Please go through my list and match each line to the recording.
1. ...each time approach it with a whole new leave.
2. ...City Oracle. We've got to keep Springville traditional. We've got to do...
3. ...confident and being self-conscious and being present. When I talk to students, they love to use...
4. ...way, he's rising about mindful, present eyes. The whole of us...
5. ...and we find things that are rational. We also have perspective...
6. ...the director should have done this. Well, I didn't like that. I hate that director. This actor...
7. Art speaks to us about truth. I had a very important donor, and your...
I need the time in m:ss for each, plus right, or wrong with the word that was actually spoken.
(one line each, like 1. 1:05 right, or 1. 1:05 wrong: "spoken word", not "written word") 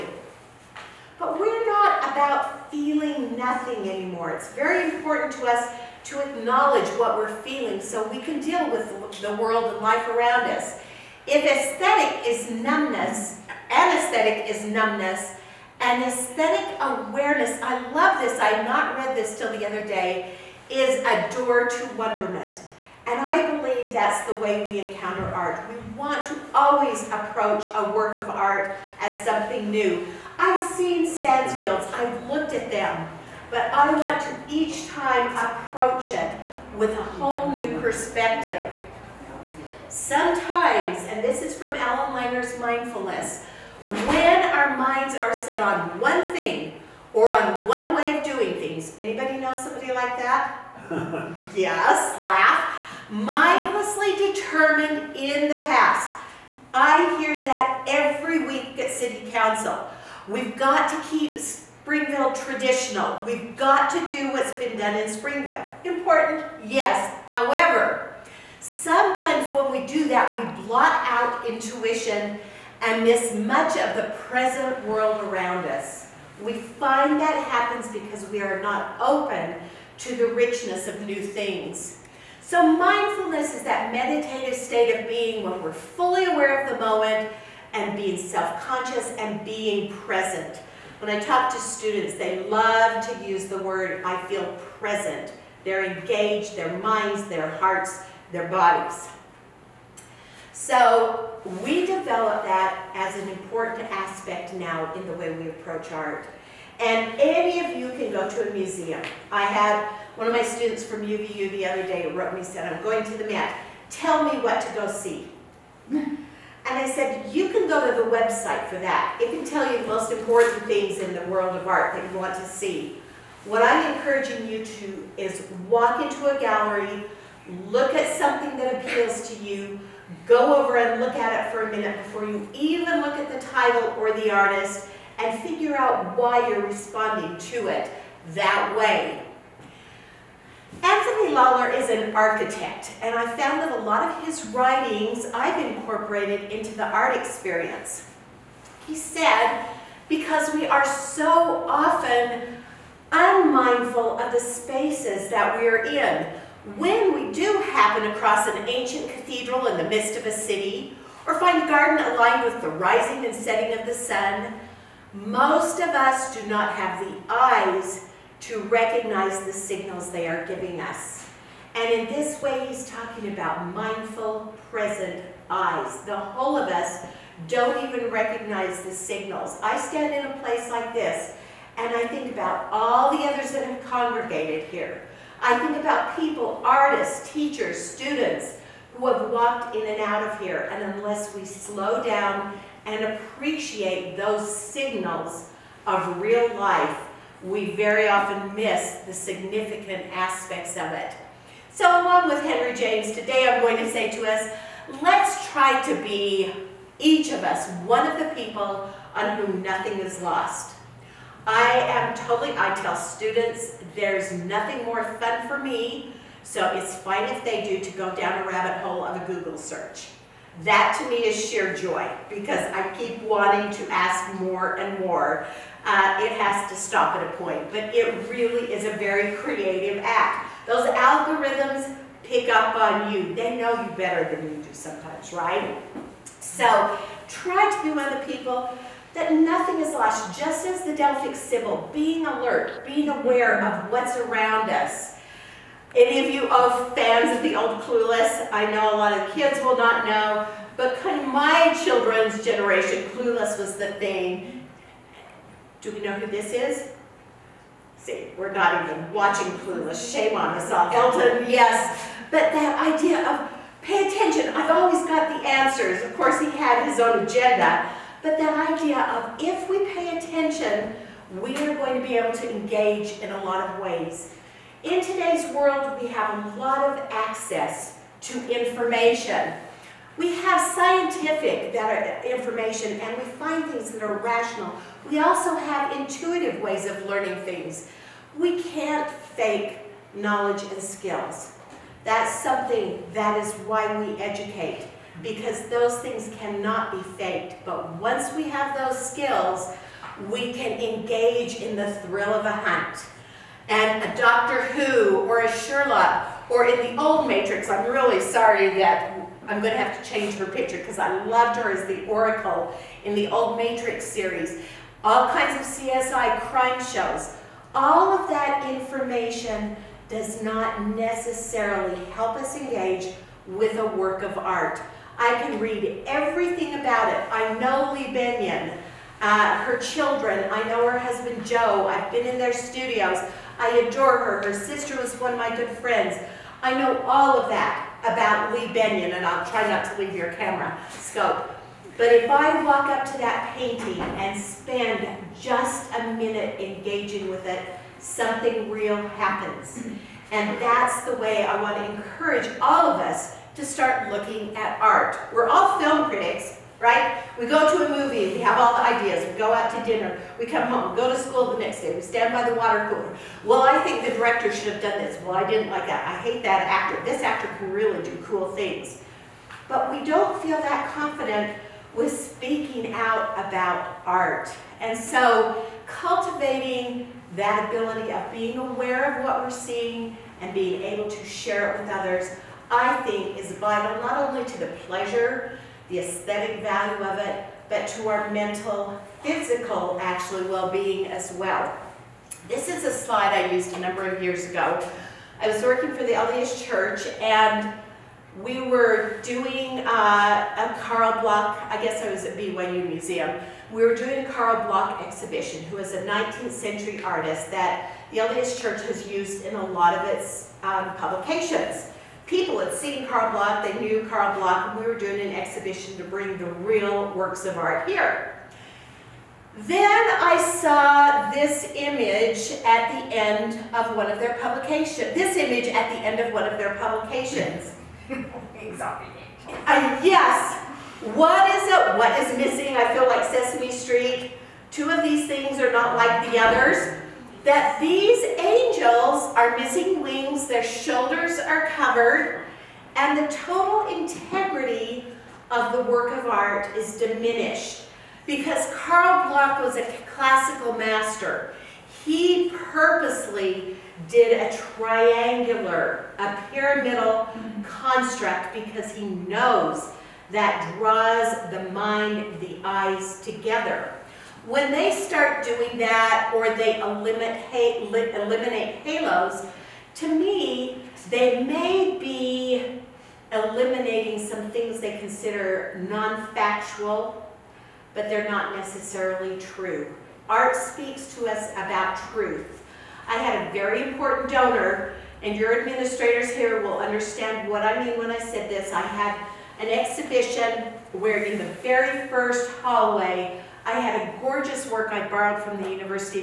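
1. 0:34 wrong: "perspective", not "leave"
2. 0:58 wrong: "Council", not "Oracle"
3. 1:26 wrong: "moment", not "confident"
4. 2:52 wrong: "talking", not "rising"
5. 4:42 wrong: "intuitive", not "perspective"
6. 6:04 wrong: "actor", not "director"
7. 8:00 right.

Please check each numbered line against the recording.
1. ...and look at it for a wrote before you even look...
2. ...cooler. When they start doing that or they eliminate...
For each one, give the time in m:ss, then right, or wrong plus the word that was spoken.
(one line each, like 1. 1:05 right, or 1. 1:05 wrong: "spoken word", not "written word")
1. 2:10 wrong: "minute", not "wrote"
2. 7:43 wrong: "together", not "cooler".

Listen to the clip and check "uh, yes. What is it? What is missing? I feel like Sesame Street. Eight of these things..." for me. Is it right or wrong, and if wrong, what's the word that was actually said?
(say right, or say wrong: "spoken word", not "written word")
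wrong: "Two", not "Eight".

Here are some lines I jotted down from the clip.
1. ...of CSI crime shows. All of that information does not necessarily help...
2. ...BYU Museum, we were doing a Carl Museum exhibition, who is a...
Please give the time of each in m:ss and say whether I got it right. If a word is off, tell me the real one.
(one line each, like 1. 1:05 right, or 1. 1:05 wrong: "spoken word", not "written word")
1. 5:15 right
2. 6:42 wrong: "Bloch", not "Museum".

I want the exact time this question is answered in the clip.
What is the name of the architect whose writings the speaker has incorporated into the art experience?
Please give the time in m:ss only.
2:20.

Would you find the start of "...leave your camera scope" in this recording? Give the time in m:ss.
5:39.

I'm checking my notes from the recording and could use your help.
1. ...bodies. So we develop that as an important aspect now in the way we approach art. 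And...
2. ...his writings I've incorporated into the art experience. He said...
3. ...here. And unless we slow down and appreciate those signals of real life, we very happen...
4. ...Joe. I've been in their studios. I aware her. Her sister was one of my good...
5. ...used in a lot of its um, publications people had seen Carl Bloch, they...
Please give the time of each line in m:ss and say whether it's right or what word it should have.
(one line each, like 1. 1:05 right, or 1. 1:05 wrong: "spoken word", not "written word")
1. 1:38 right
2. 2:24 right
3. 3:10 wrong: "often", not "happen"
4. 5:31 wrong: "adore", not "aware"
5. 6:49 right.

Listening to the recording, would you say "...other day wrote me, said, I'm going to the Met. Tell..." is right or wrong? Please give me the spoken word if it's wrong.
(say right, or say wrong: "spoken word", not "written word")
right.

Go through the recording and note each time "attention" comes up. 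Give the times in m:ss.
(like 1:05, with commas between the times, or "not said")
4:24, 4:30.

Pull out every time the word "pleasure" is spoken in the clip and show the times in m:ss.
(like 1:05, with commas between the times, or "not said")
6:24.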